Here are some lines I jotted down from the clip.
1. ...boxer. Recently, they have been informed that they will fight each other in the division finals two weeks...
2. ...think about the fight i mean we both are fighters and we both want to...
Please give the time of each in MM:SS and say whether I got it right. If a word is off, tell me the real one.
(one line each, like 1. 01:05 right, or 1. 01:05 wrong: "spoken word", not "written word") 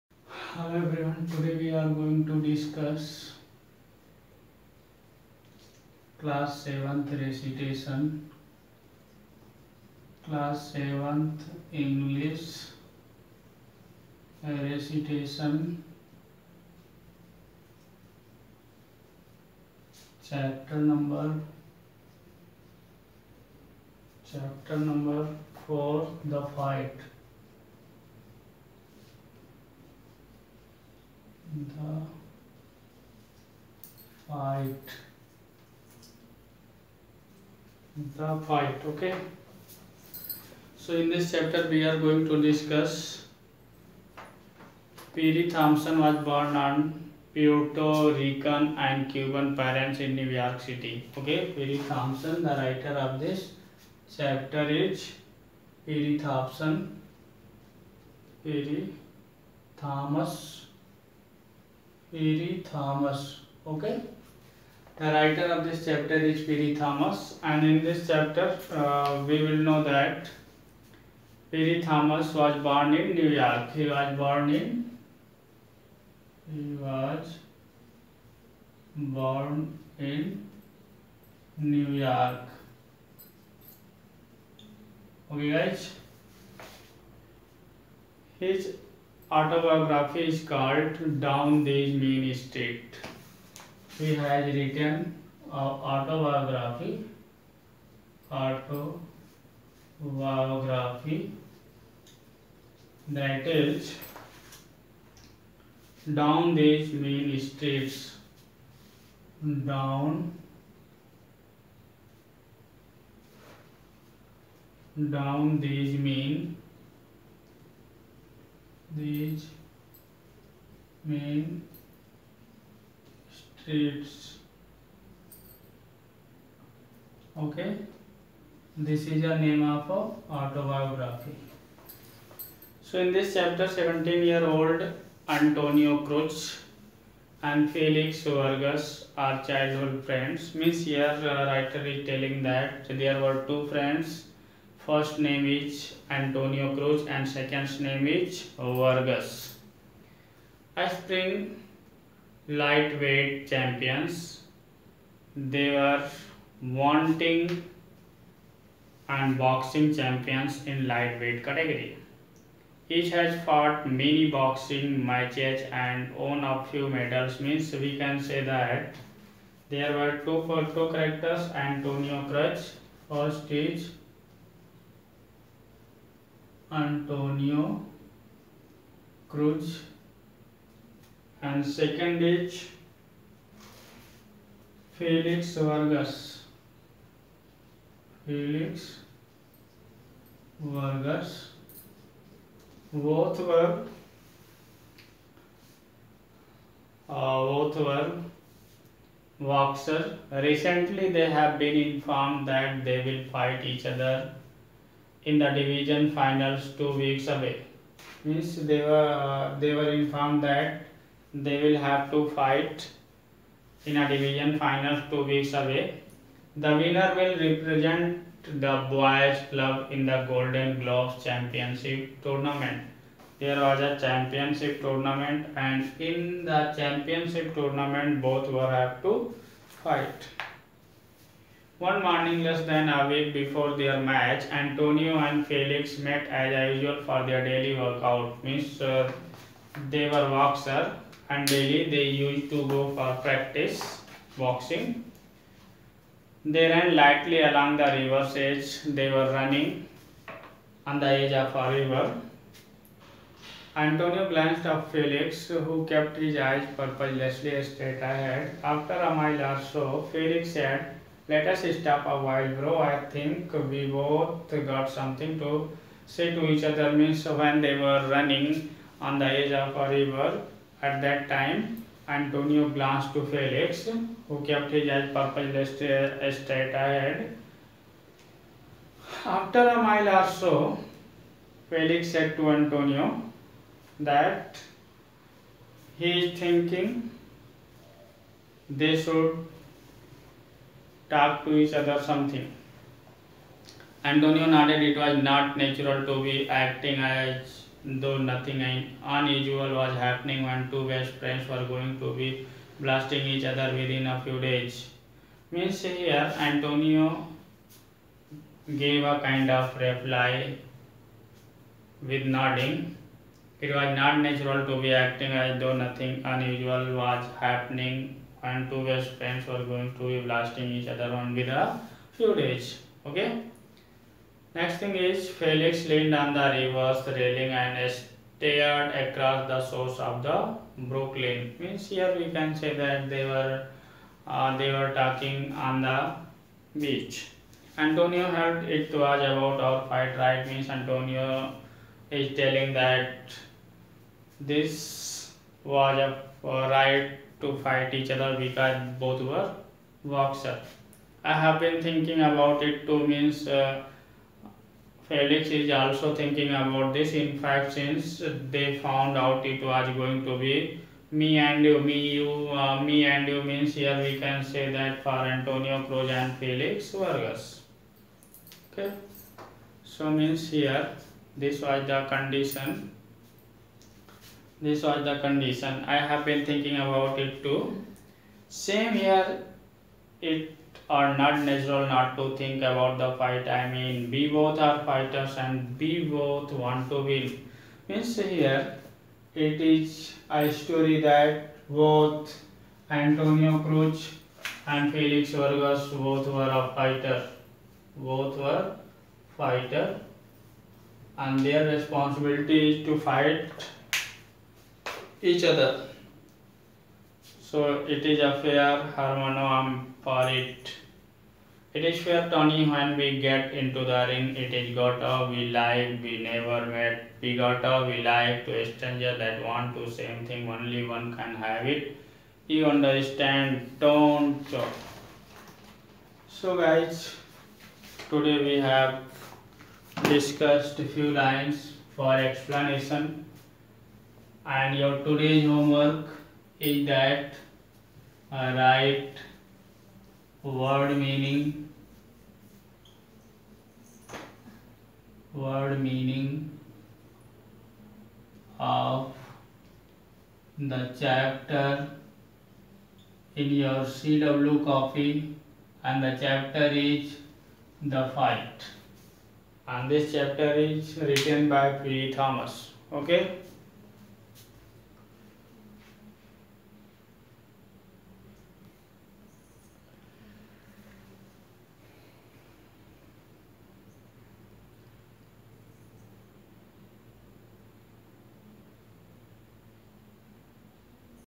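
1. 03:19 right
2. 06:22 right.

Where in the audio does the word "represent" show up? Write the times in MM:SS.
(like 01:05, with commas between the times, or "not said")
03:37.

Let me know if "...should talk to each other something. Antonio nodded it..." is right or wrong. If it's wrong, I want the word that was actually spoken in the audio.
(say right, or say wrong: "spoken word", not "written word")
right.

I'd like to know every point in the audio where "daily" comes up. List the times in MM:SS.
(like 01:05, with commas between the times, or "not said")
03:57, 04:01.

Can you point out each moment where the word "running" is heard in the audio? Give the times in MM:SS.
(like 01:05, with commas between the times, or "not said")
04:09, 04:28.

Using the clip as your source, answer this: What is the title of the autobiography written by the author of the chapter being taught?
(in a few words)
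Down These Mean Streets.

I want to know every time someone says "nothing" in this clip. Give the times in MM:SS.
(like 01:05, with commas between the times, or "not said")
04:58, 05:15.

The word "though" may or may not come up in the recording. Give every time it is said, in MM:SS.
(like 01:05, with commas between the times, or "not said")
04:58, 05:15.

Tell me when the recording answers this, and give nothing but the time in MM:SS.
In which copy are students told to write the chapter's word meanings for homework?
07:33.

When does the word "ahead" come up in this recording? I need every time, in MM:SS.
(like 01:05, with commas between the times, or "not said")
04:18, 04:36.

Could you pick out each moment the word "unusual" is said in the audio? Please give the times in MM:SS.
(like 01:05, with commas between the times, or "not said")
04:59, 05:16.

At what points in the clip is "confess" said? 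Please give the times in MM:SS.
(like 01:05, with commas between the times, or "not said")
not said.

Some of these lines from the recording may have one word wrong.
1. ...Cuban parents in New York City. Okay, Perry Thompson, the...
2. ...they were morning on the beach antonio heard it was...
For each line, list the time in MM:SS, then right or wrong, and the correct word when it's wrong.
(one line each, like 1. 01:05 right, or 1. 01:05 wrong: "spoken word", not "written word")
1. 00:49 right
2. 05:34 wrong: "talking", not "morning".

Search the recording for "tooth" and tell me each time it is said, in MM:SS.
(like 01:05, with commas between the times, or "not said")
not said.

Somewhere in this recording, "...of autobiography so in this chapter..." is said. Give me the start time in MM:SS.
02:09.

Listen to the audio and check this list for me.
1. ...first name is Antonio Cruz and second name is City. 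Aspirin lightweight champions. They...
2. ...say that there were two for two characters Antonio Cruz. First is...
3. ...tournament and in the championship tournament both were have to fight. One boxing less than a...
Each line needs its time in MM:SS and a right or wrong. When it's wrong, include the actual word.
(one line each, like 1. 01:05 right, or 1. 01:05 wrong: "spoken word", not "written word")
1. 02:24 wrong: "Vargas", not "City"
2. 02:48 right
3. 03:44 wrong: "morning", not "boxing".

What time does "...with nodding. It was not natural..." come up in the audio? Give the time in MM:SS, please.
05:12.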